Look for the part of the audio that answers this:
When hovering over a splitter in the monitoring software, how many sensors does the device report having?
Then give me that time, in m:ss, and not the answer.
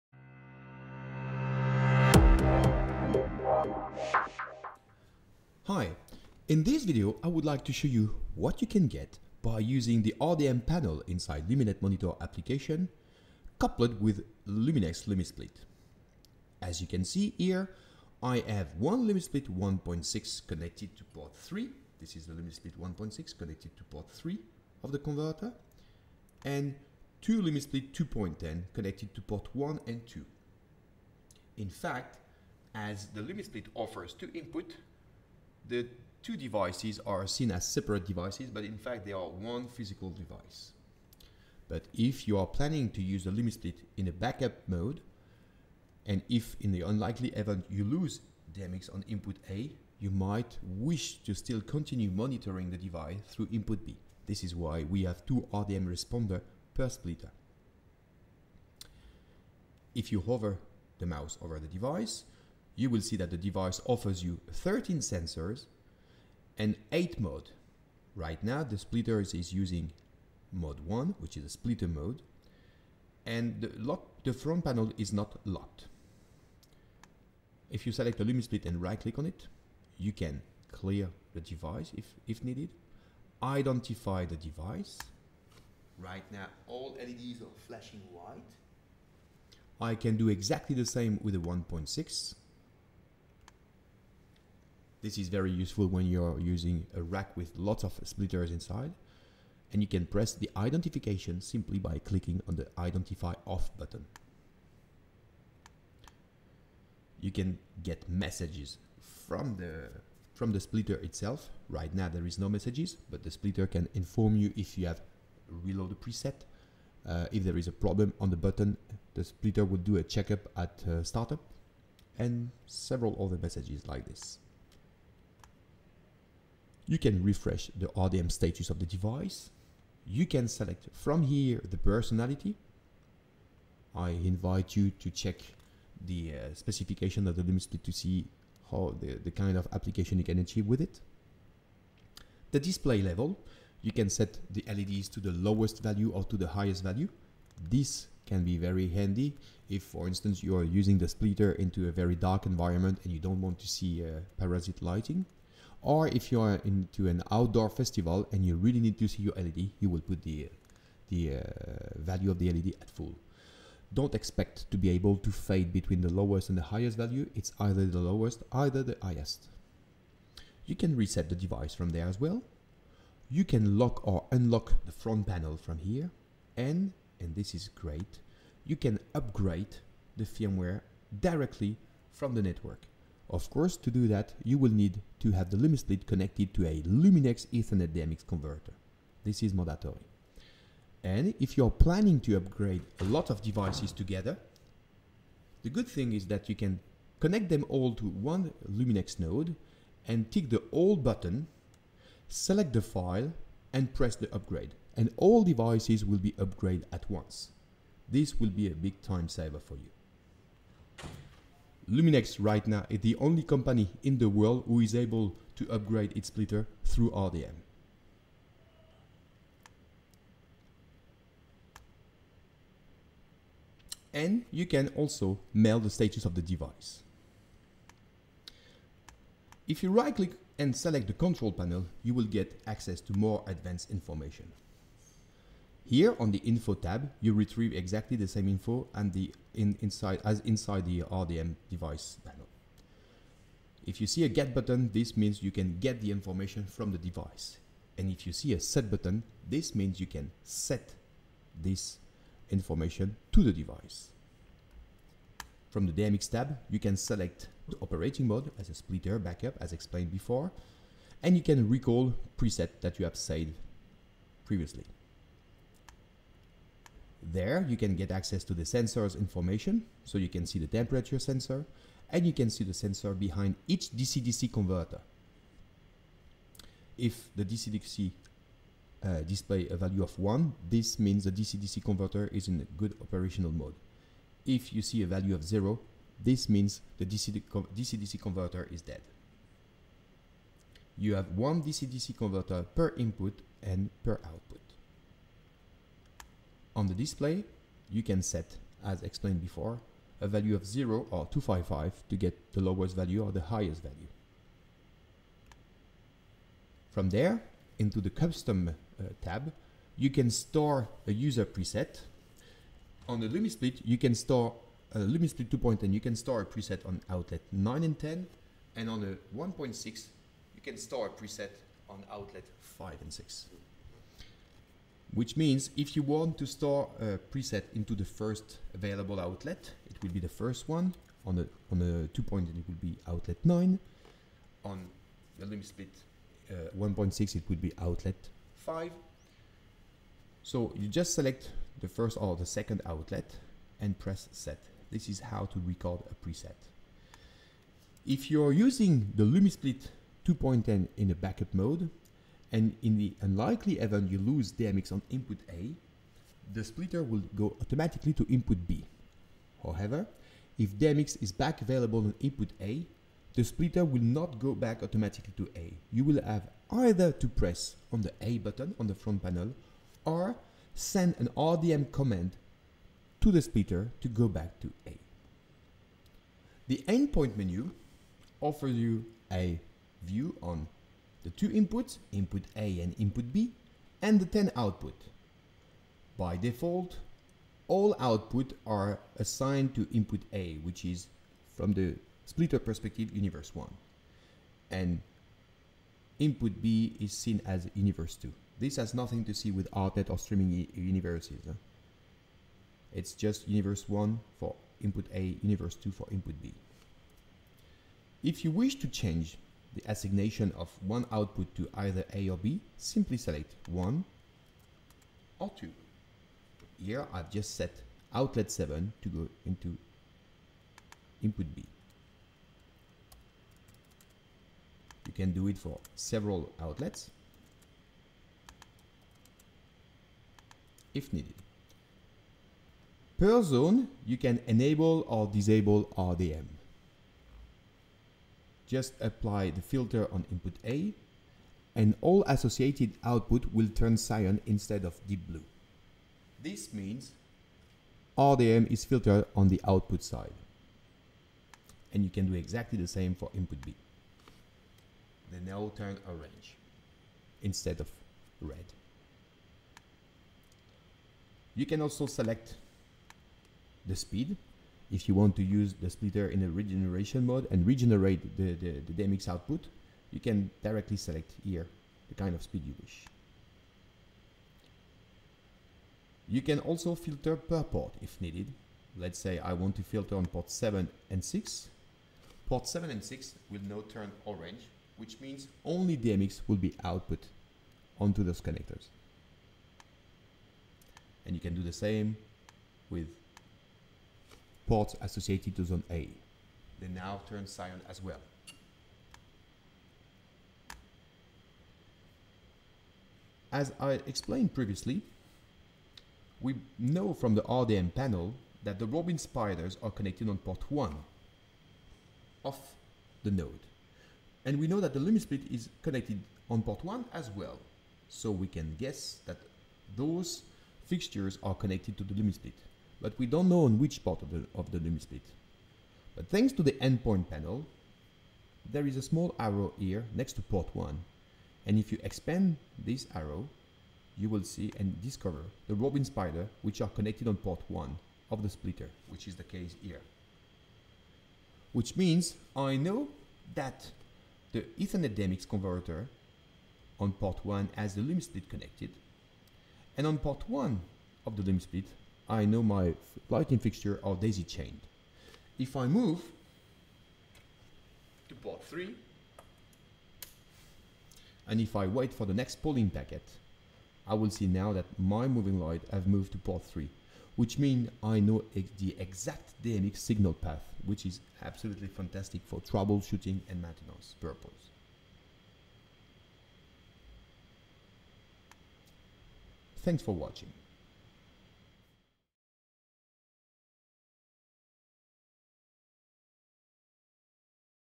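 1:04.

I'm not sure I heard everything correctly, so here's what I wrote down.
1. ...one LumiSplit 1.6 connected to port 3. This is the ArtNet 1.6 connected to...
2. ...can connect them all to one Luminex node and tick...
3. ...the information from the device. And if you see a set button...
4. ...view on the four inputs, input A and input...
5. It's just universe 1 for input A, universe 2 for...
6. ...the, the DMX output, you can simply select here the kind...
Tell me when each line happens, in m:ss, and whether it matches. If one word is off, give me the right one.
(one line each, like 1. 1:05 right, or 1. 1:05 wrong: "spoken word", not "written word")
1. 0:18 wrong: "LumiSplit", not "ArtNet"
2. 3:16 right
3. 4:06 right
4. 6:20 wrong: "two", not "four"
5. 6:42 right
6. 7:48 wrong: "directly", not "simply".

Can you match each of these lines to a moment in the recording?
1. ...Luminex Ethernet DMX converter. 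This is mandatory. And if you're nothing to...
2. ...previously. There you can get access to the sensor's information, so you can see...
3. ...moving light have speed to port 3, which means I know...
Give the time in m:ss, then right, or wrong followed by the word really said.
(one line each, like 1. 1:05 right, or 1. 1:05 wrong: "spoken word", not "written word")
1. 3:06 wrong: "planning", not "nothing"
2. 4:24 right
3. 9:25 wrong: "moved", not "speed".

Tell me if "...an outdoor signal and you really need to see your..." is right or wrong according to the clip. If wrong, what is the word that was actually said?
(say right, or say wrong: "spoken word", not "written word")
wrong: "festival", not "signal".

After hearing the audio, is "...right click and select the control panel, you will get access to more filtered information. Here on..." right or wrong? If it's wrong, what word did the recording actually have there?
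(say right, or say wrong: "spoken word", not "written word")
wrong: "advanced", not "filtered".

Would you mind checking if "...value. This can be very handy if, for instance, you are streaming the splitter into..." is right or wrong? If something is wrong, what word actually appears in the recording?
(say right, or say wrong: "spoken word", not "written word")
wrong: "using", not "streaming".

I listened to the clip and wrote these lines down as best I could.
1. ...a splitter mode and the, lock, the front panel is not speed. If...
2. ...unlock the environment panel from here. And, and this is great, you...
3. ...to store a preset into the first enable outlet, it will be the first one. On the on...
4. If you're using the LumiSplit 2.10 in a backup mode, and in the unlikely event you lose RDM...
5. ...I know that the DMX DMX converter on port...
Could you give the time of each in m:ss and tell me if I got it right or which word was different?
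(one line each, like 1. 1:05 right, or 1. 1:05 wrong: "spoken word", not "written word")
1. 1:11 wrong: "locked", not "speed"
2. 2:54 wrong: "front", not "environment"
3. 5:26 wrong: "available", not "enable"
4. 5:48 wrong: "DMX", not "RDM"
5. 9:02 wrong: "Ethernet", not "DMX".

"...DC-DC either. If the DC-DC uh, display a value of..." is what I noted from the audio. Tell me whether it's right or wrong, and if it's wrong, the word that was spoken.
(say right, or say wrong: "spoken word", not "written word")
wrong: "converter", not "either".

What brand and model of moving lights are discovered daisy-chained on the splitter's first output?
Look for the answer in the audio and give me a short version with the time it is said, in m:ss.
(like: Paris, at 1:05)
Robin Spiider, at 8:55.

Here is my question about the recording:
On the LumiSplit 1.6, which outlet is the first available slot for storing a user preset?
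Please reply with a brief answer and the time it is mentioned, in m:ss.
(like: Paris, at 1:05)
Outlet 5, at 5:37.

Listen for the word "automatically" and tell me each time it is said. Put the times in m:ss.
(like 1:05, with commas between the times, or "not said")
5:57, 6:04.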